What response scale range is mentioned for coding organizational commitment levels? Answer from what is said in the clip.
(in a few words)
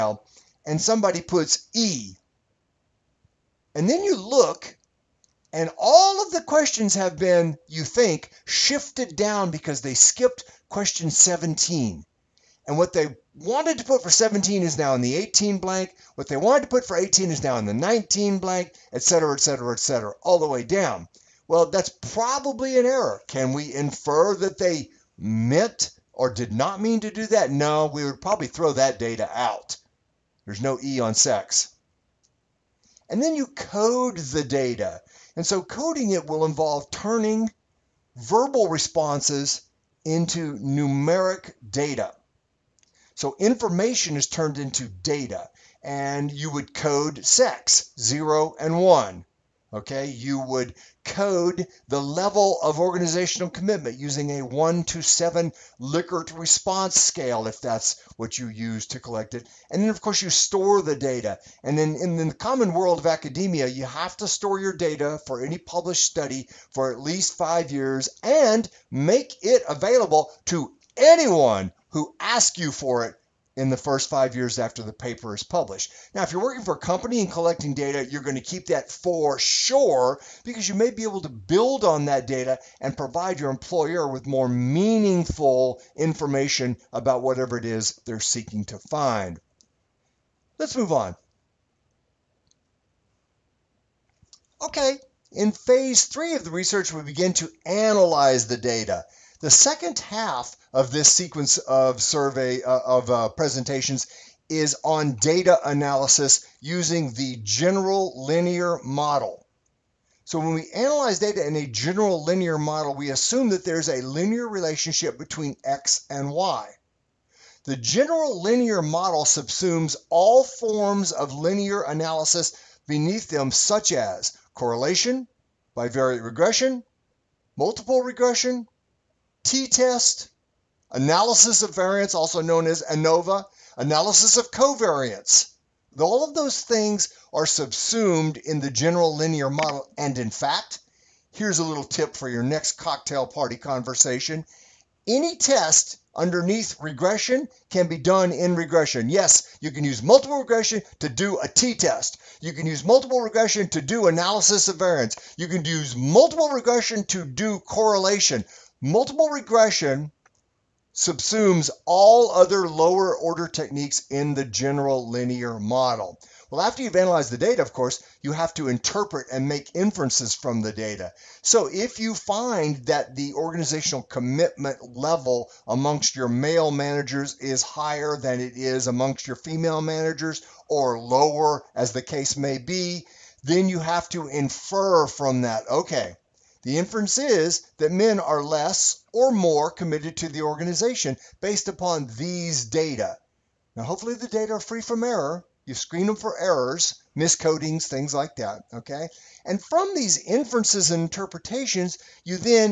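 1 to 7.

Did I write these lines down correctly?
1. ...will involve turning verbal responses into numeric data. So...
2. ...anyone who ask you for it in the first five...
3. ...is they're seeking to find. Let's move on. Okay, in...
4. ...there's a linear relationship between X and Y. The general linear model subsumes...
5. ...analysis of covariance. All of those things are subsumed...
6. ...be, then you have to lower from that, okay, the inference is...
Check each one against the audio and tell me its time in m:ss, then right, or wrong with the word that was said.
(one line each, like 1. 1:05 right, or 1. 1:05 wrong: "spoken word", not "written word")
1. 0:36 right
2. 1:10 right
3. 1:27 right
4. 1:53 right
5. 2:13 right
6. 3:02 wrong: "infer", not "lower".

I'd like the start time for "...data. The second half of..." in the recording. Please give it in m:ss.
1:38.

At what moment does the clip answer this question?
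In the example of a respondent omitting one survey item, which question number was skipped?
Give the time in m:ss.
0:10.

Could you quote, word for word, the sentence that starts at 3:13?
Now, hopefully, the data are free from error.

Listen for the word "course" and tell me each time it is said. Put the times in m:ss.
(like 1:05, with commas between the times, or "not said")
1:00, 2:47.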